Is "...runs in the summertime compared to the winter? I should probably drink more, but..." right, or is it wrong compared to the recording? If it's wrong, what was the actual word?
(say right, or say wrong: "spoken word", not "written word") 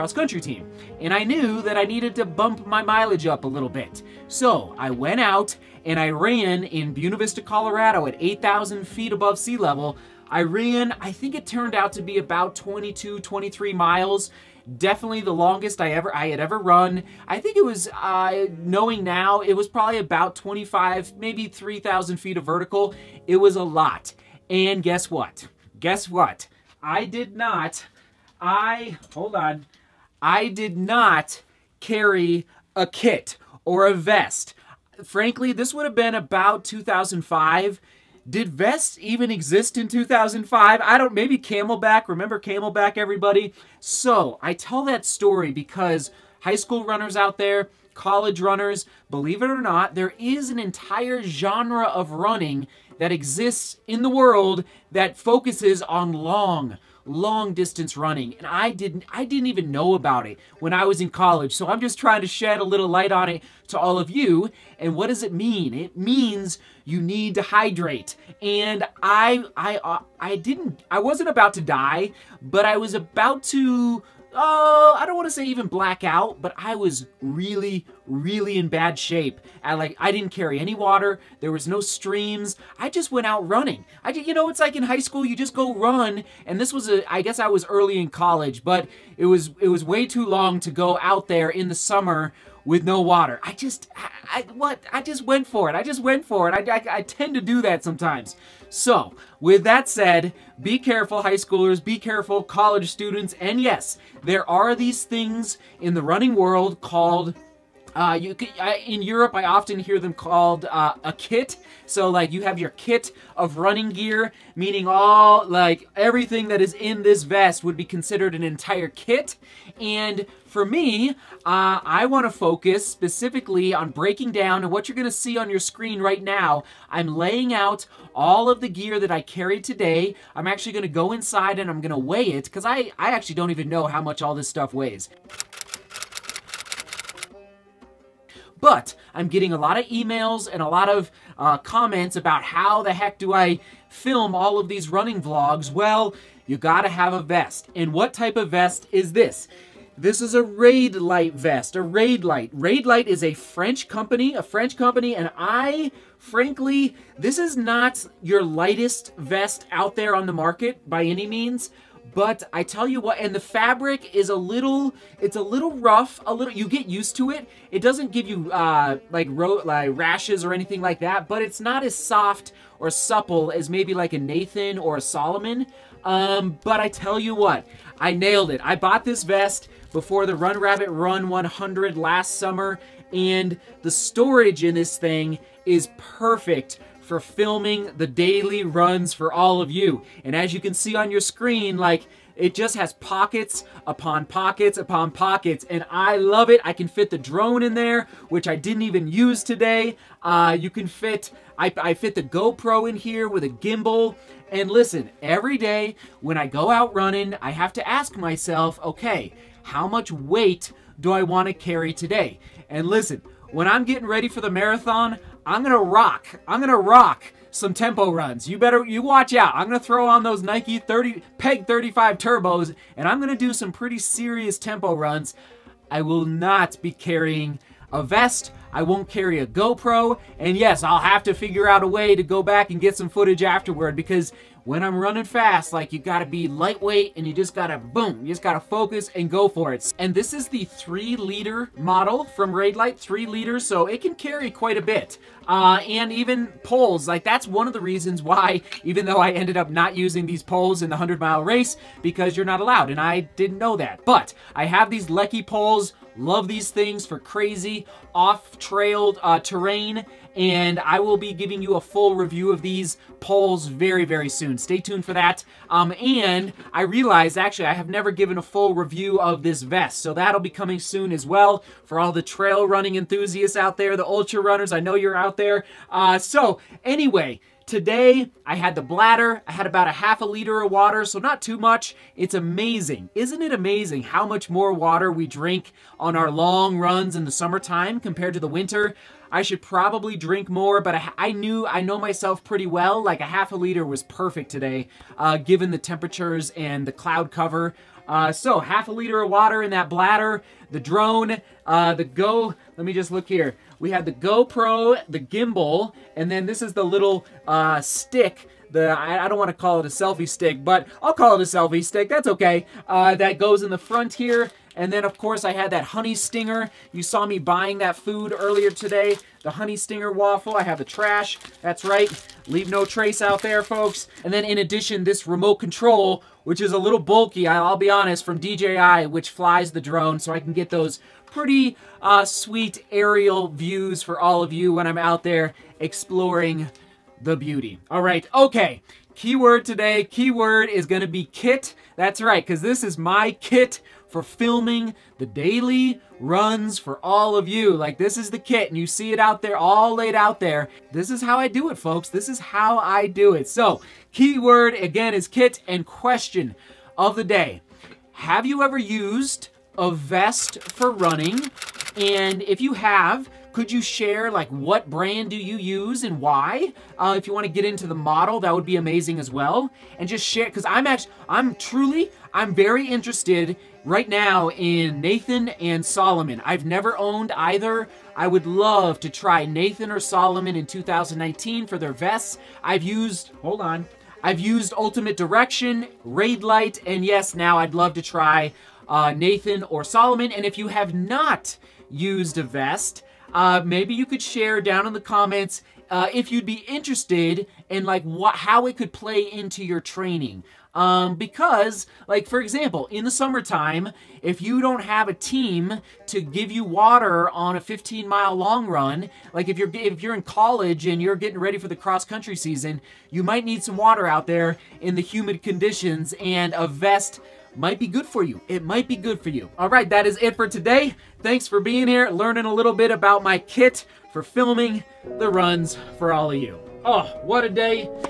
right.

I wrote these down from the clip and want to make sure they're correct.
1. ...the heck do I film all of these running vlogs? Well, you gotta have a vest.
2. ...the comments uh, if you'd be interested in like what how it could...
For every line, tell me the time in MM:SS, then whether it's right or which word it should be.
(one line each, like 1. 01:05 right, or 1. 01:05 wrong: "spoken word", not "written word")
1. 02:22 right
2. 06:34 right.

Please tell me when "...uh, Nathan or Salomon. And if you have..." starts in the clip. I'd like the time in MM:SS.
06:28.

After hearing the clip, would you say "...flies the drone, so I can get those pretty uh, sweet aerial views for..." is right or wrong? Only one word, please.
right.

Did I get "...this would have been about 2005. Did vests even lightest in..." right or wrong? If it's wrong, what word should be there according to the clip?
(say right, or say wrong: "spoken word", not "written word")
wrong: "exist", not "lightest".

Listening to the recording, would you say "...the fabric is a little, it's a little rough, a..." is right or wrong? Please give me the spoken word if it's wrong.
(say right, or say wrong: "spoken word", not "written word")
right.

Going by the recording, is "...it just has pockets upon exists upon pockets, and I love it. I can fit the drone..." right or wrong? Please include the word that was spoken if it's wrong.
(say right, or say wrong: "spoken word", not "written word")
wrong: "pockets", not "exists".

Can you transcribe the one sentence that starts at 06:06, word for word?
Uh, if you want to get into the model, that would be amazing as well.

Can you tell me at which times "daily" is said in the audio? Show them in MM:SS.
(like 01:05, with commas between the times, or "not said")
03:08, 05:45.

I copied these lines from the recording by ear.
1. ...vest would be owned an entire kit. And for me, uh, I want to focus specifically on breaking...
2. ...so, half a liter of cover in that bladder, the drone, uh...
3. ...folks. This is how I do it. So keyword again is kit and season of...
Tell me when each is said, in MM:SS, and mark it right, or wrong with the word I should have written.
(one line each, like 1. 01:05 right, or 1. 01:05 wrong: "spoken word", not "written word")
1. 01:57 wrong: "considered", not "owned"
2. 04:58 wrong: "water", not "cover"
3. 05:51 wrong: "question", not "season".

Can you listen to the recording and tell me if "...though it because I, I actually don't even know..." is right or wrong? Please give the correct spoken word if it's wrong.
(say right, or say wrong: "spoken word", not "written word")
wrong: "weigh", not "though".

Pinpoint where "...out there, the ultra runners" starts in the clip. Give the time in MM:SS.
04:33.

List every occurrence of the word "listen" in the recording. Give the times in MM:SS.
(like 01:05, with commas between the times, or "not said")
03:24, 03:32.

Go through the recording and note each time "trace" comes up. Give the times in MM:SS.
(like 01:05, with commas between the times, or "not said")
05:22.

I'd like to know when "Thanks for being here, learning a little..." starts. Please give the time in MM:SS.
07:01.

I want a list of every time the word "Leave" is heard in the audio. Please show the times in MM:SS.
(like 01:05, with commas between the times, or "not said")
05:22.